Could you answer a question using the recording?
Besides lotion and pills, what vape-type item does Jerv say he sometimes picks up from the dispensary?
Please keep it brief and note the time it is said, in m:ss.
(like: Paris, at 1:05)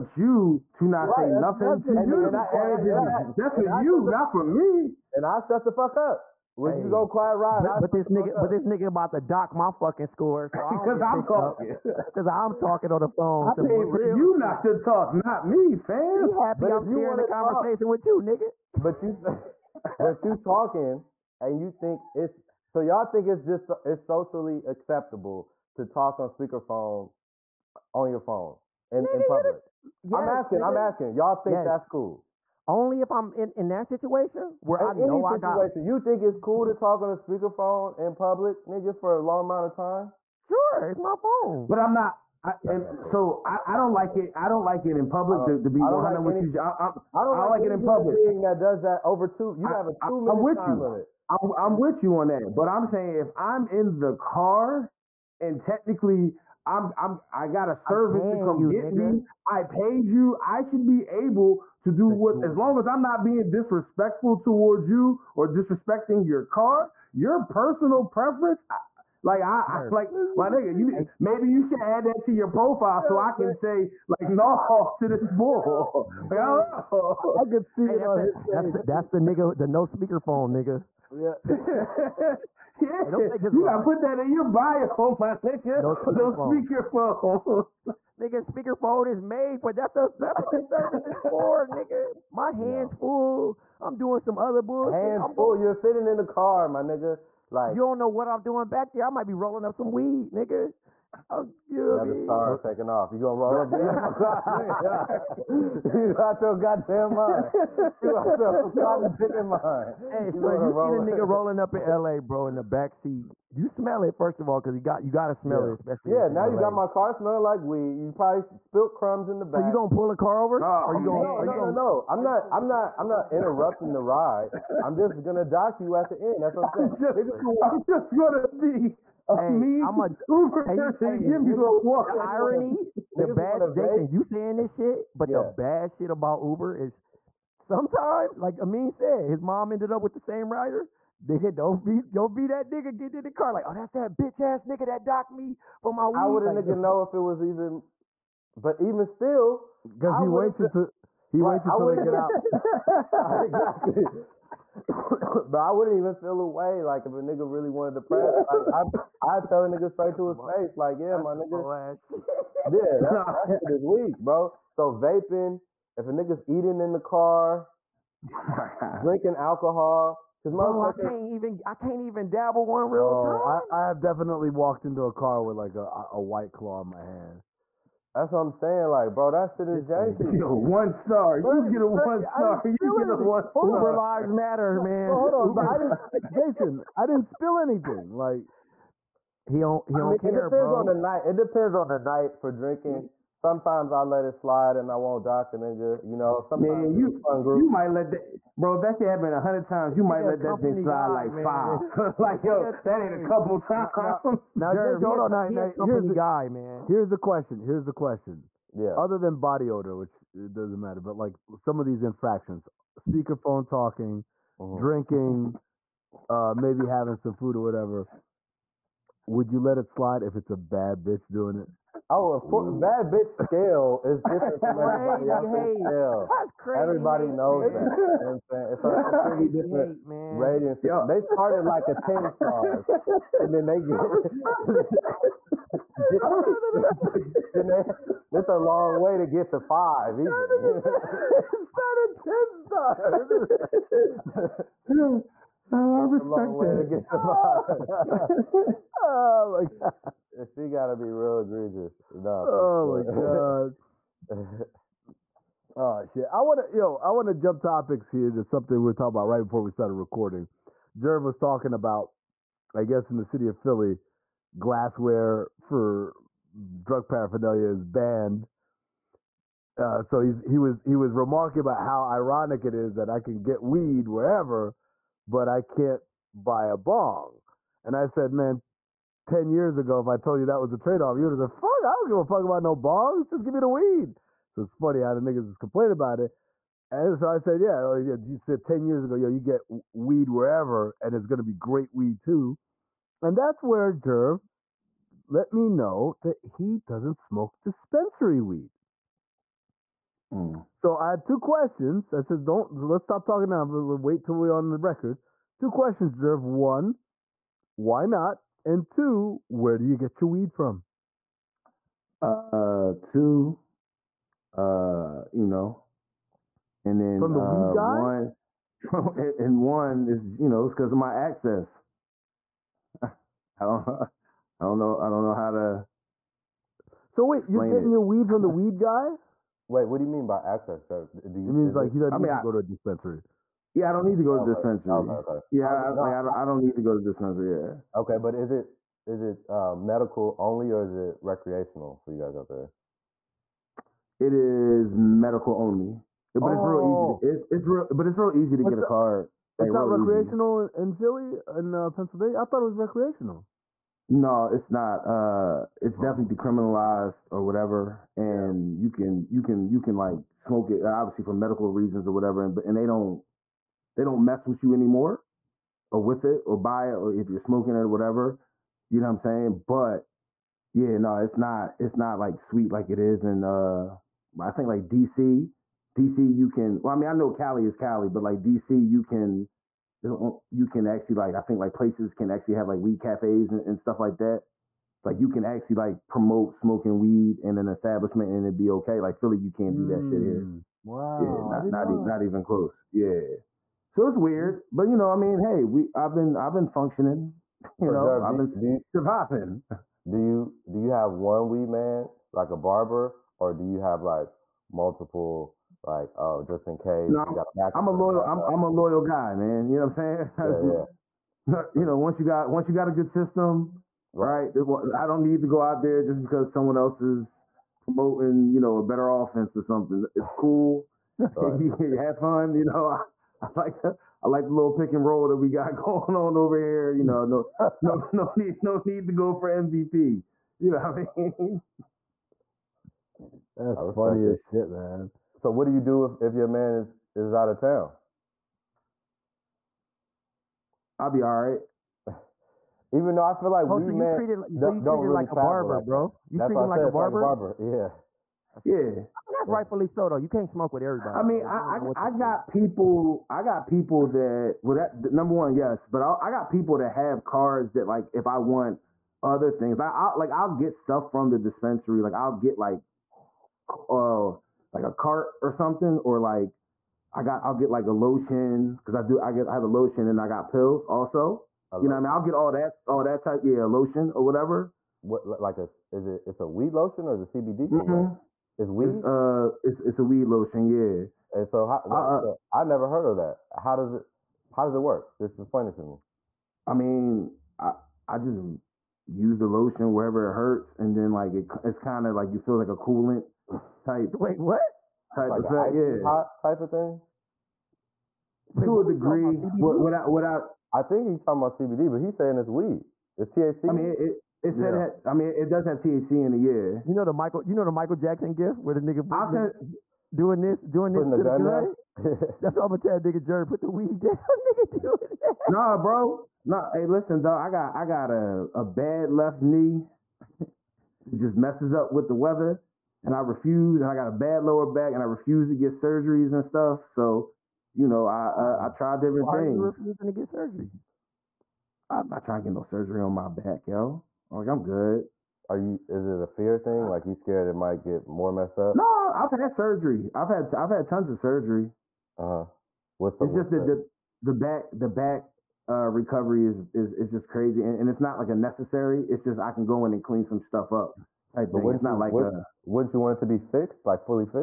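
A cart, at 7:44.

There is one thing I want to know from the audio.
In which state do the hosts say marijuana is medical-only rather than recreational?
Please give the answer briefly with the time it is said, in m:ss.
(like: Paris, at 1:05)
Pennsylvania, at 5:51.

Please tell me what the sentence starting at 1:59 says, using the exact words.
So you gonna pull a car over?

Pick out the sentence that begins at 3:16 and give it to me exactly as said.
You know, sometimes man, you you might let that bro.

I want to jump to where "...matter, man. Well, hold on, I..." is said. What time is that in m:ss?
3:04.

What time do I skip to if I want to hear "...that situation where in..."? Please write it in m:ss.
0:33.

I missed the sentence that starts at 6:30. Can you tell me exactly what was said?
Mm, wow, yeah, not not, e- not even close.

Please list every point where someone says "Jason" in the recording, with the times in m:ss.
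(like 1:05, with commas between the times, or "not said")
2:13, 3:06.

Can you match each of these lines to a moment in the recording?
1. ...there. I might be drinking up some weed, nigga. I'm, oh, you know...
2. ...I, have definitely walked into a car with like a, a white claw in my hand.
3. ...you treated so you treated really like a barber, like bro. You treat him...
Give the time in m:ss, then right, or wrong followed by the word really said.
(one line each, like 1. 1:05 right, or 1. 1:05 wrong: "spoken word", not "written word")
1. 1:38 wrong: "rolling", not "drinking"
2. 2:53 right
3. 7:23 right.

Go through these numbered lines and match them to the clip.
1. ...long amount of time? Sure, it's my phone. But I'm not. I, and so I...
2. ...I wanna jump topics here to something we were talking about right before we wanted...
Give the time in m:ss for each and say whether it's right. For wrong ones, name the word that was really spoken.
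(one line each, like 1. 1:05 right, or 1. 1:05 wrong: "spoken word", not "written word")
1. 0:39 right
2. 4:17 wrong: "started", not "wanted".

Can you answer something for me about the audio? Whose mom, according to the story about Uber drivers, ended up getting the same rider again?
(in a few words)
Amin.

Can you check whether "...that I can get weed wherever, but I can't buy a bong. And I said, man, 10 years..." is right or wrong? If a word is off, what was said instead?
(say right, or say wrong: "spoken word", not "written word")
right.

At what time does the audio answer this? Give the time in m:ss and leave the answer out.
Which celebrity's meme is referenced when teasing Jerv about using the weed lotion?
8:27.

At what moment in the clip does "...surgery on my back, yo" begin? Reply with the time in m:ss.
8:52.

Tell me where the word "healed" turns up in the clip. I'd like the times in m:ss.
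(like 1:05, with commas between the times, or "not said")
not said.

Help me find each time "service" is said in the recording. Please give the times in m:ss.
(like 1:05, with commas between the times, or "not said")
0:57, 1:30.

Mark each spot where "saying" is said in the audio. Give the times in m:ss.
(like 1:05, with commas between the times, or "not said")
0:52, 2:06, 2:14, 2:58, 3:48, 6:09, 6:50, 8:22.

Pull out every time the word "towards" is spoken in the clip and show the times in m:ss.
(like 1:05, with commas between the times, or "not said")
1:04.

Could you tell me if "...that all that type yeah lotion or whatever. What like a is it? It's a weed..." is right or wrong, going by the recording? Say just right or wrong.
right.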